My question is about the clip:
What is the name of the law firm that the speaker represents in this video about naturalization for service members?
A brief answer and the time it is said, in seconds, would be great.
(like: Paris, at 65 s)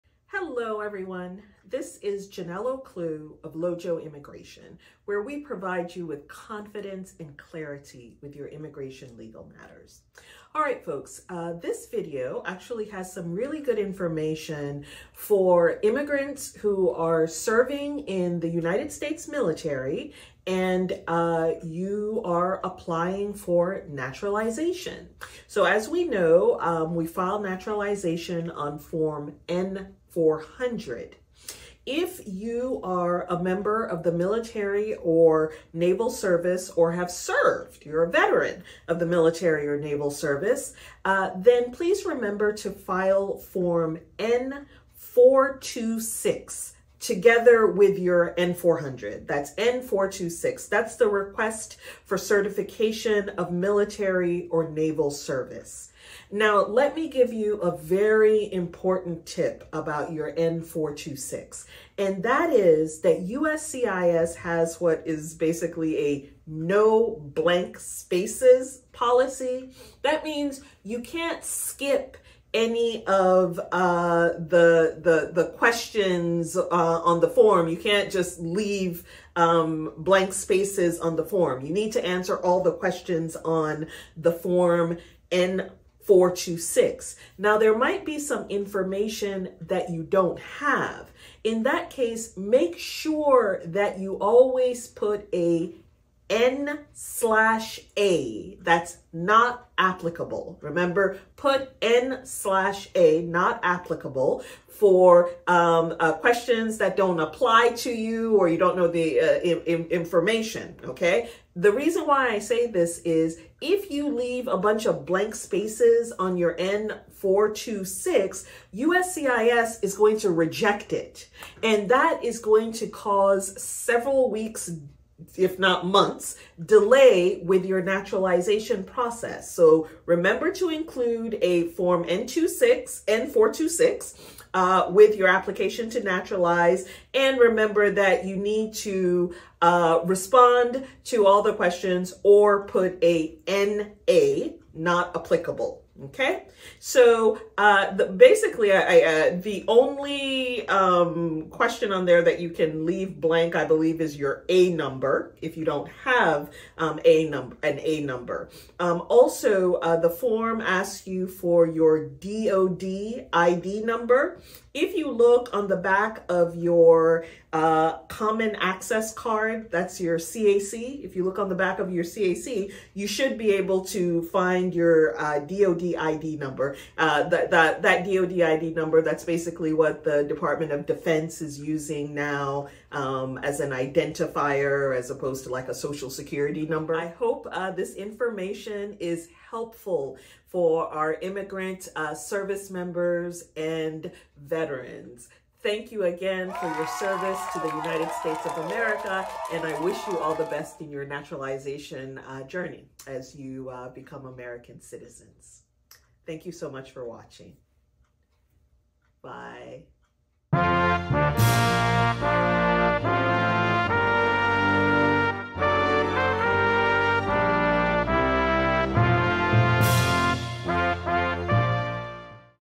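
Lojo Immigration, at 3 s.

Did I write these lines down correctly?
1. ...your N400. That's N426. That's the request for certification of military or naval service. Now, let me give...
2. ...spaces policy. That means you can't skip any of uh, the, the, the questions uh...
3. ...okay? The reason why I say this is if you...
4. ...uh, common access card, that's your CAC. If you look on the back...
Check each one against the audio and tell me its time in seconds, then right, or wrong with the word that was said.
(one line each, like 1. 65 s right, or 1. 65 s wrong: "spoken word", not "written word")
1. 47 s right
2. 67 s right
3. 110 s right
4. 167 s right.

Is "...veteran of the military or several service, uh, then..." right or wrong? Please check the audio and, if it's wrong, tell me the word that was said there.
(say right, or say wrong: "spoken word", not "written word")
wrong: "naval", not "several".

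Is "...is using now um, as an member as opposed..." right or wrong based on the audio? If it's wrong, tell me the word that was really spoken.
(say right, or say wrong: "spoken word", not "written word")
wrong: "identifier", not "member".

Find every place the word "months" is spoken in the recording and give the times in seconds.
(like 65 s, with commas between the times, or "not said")
125 s.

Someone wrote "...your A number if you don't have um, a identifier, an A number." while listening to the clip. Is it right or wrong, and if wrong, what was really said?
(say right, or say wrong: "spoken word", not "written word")
wrong: "number", not "identifier".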